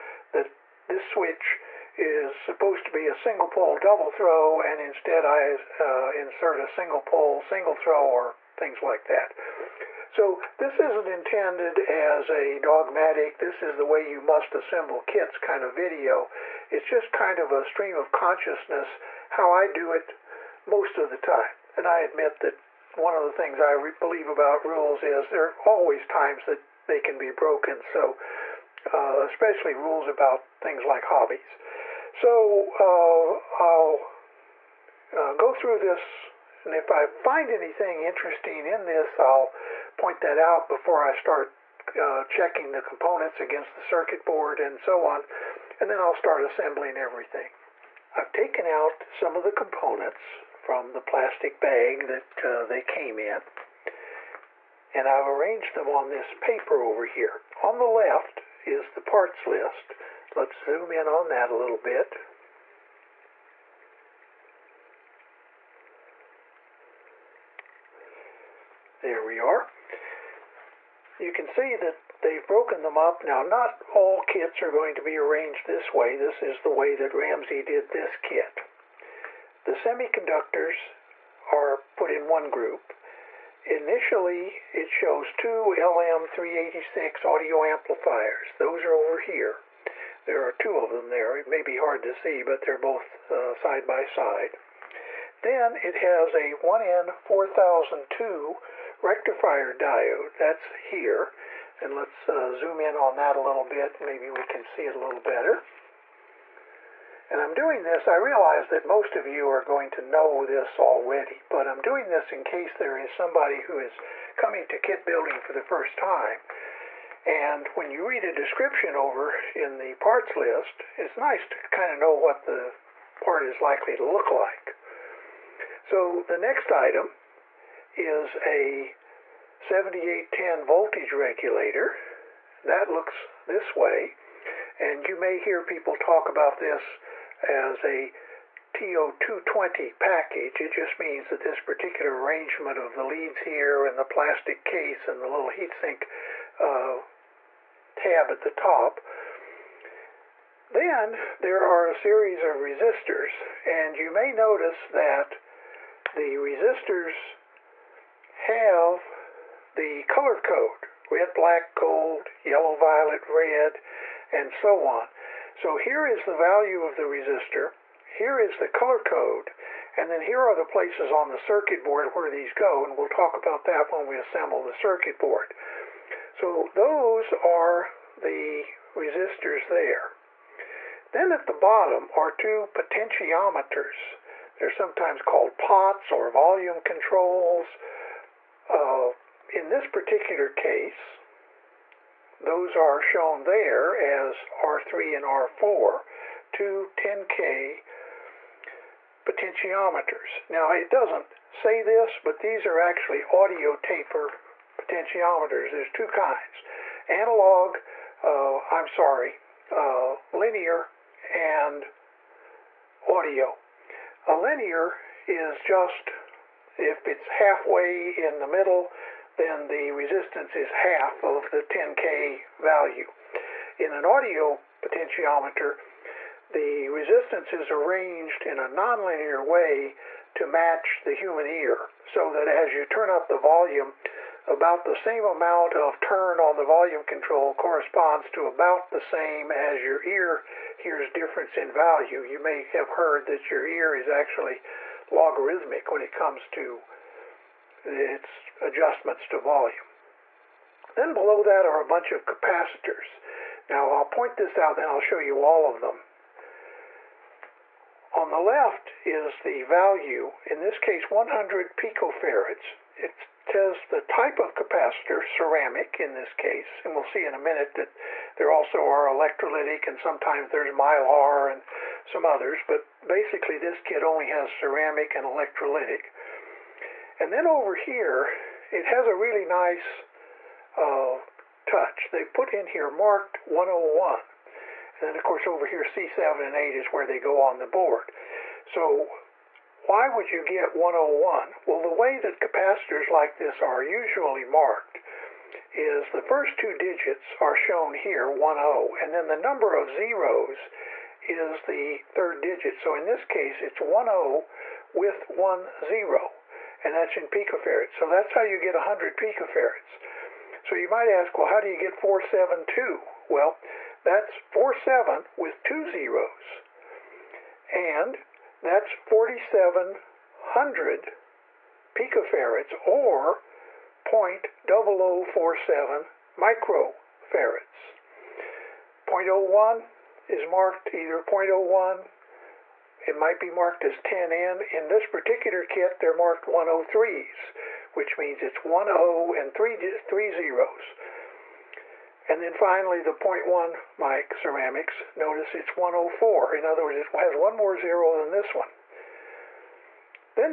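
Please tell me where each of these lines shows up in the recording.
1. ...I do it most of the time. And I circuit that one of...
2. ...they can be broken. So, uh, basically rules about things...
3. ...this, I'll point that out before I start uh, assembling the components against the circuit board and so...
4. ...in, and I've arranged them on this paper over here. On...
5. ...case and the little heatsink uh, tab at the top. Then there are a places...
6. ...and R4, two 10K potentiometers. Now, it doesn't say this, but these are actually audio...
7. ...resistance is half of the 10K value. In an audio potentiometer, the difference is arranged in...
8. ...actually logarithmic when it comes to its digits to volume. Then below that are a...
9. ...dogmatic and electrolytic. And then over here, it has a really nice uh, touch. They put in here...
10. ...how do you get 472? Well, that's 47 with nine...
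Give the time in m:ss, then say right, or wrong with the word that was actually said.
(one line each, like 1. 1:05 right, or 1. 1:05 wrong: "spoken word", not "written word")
1. 0:19 wrong: "admit", not "circuit"
2. 0:26 wrong: "especially", not "basically"
3. 0:38 wrong: "checking", not "assembling"
4. 0:53 right
5. 2:24 wrong: "series", not "places"
6. 3:15 right
7. 3:39 wrong: "resistance", not "difference"
8. 4:04 wrong: "adjustments", not "digits"
9. 4:34 wrong: "ceramic", not "dogmatic"
10. 5:11 wrong: "two", not "nine".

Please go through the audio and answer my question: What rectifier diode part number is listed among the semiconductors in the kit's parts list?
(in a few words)
1N4002.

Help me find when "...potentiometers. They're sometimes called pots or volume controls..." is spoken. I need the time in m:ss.
3:02.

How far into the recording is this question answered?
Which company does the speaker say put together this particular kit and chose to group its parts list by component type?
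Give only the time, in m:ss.
1:17.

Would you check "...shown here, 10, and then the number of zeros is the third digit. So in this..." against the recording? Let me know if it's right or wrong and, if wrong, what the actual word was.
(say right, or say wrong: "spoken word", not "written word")
right.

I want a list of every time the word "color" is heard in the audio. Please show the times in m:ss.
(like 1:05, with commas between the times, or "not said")
2:40, 2:48.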